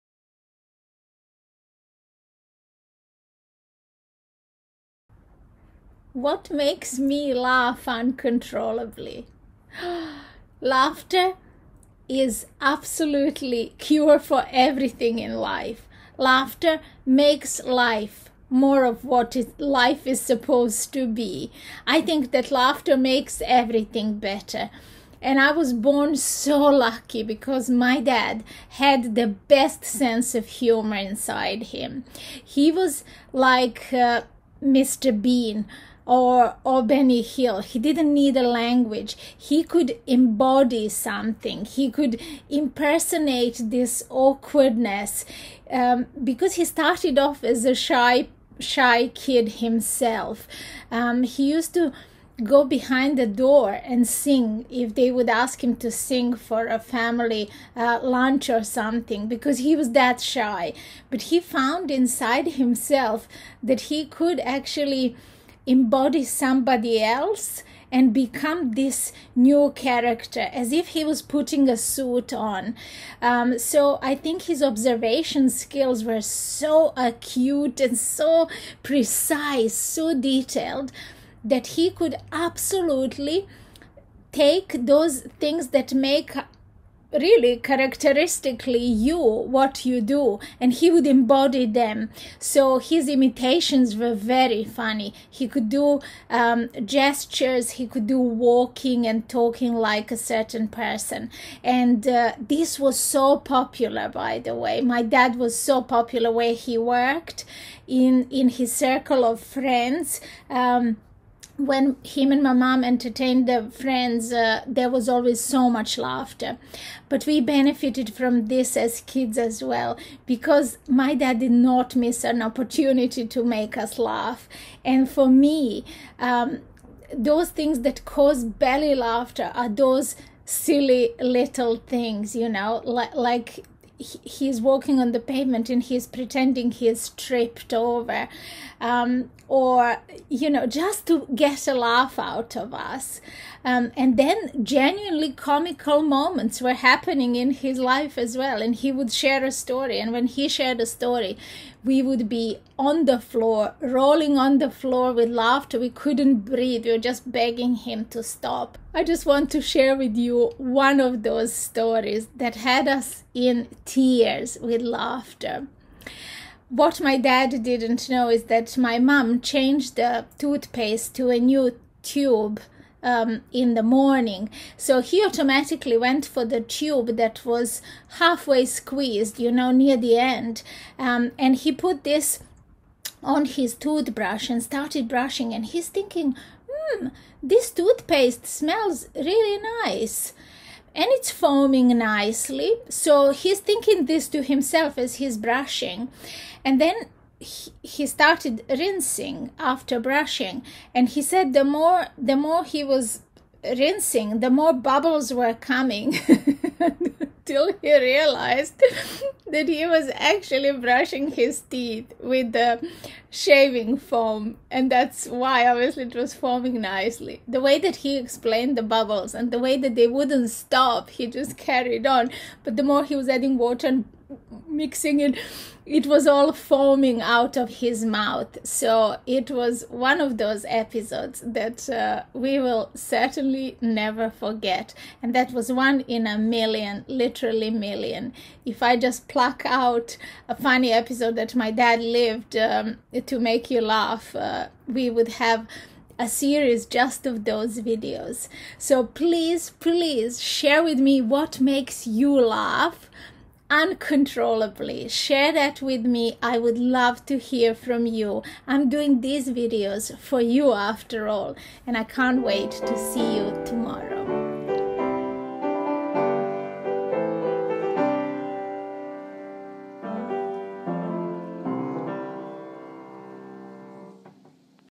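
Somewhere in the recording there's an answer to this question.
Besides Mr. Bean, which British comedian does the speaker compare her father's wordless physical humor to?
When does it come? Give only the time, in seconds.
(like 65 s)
36 s.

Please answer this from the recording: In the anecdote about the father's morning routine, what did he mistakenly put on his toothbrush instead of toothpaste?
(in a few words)
shaving foam.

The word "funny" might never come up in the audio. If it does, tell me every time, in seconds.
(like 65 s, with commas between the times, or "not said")
94 s, 240 s.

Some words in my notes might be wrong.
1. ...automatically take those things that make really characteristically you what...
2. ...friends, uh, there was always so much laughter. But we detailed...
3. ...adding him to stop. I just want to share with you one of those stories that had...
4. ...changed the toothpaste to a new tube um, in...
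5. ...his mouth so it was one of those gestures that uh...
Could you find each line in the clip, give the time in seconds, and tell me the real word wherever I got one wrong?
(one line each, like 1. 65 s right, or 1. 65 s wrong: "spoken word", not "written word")
1. 82 s wrong: "absolutely", not "automatically"
2. 113 s wrong: "benefited", not "detailed"
3. 157 s wrong: "begging", not "adding"
4. 169 s right
5. 227 s wrong: "episodes", not "gestures".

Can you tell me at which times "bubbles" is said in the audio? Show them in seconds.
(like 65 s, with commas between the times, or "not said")
204 s, 218 s.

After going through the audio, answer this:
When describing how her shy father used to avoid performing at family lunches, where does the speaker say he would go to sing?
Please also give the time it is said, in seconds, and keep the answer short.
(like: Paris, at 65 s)
behind the door, at 52 s.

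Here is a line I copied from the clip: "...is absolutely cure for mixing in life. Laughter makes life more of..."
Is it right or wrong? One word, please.
wrong.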